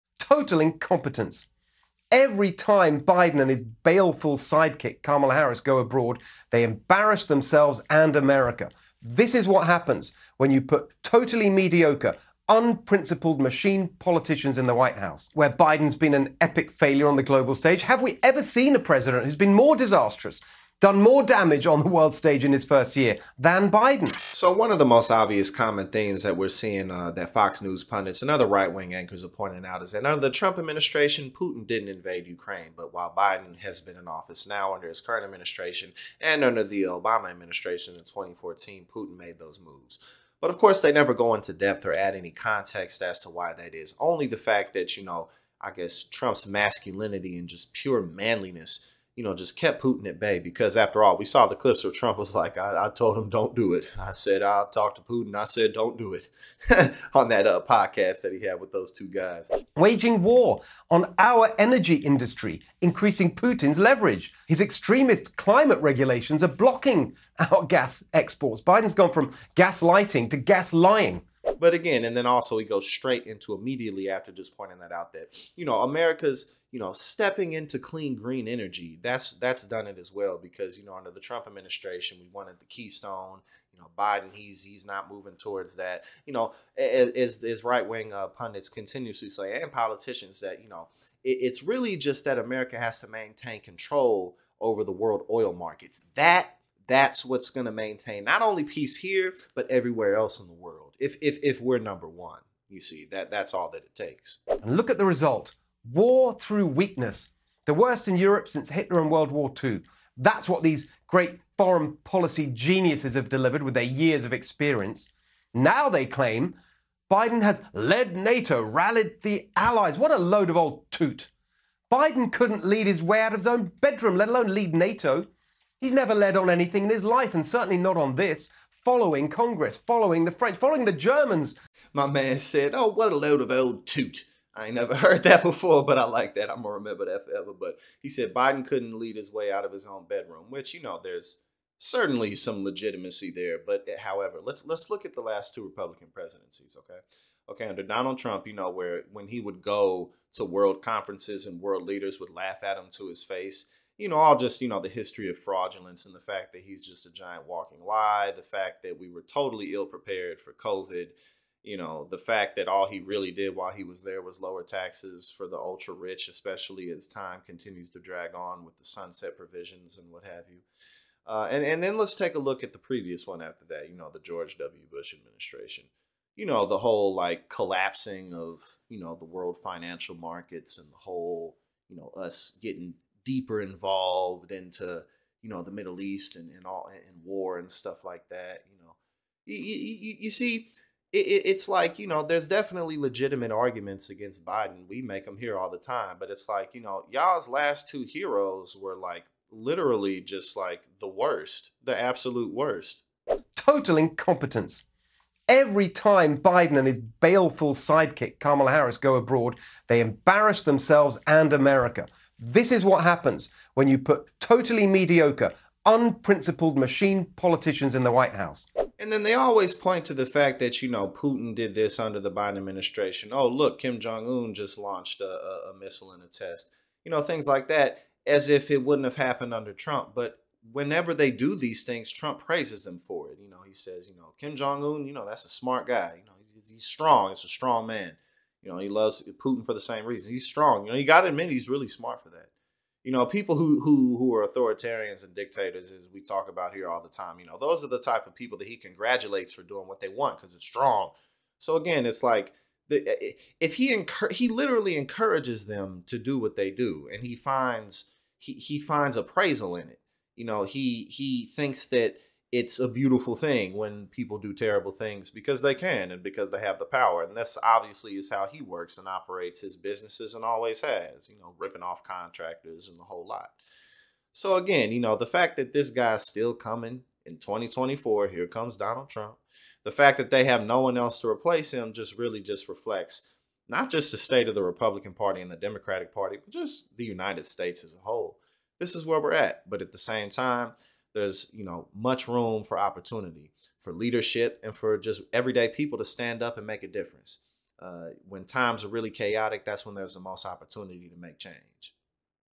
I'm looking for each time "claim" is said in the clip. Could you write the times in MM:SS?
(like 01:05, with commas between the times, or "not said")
01:56.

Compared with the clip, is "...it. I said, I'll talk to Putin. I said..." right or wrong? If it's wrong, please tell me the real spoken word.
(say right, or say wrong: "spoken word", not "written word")
right.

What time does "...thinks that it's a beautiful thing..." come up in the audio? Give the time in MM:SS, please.
04:21.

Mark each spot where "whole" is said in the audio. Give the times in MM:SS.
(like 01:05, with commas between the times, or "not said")
02:56, 03:00, 04:33, 04:48.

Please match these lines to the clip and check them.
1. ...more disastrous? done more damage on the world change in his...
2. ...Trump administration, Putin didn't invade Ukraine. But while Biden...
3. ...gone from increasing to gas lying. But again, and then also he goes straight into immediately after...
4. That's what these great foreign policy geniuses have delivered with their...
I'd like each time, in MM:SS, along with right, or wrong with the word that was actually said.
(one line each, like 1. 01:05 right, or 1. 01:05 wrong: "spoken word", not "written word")
1. 00:19 wrong: "stage", not "change"
2. 00:30 right
3. 01:08 wrong: "gaslighting", not "increasing"
4. 01:50 right.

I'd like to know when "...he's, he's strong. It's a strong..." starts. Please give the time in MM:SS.
03:56.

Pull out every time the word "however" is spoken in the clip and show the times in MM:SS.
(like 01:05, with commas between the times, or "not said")
02:23.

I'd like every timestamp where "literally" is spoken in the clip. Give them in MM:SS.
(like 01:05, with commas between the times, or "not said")
03:19, 04:14.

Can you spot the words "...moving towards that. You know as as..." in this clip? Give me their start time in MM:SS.
01:25.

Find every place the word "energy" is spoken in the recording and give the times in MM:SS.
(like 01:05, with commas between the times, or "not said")
01:01, 01:18.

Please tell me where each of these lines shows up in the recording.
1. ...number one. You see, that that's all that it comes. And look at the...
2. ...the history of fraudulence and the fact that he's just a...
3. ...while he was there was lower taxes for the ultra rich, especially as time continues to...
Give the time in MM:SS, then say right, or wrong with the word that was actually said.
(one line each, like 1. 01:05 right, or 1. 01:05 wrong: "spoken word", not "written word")
1. 01:41 wrong: "takes", not "comes"
2. 02:34 right
3. 02:43 right.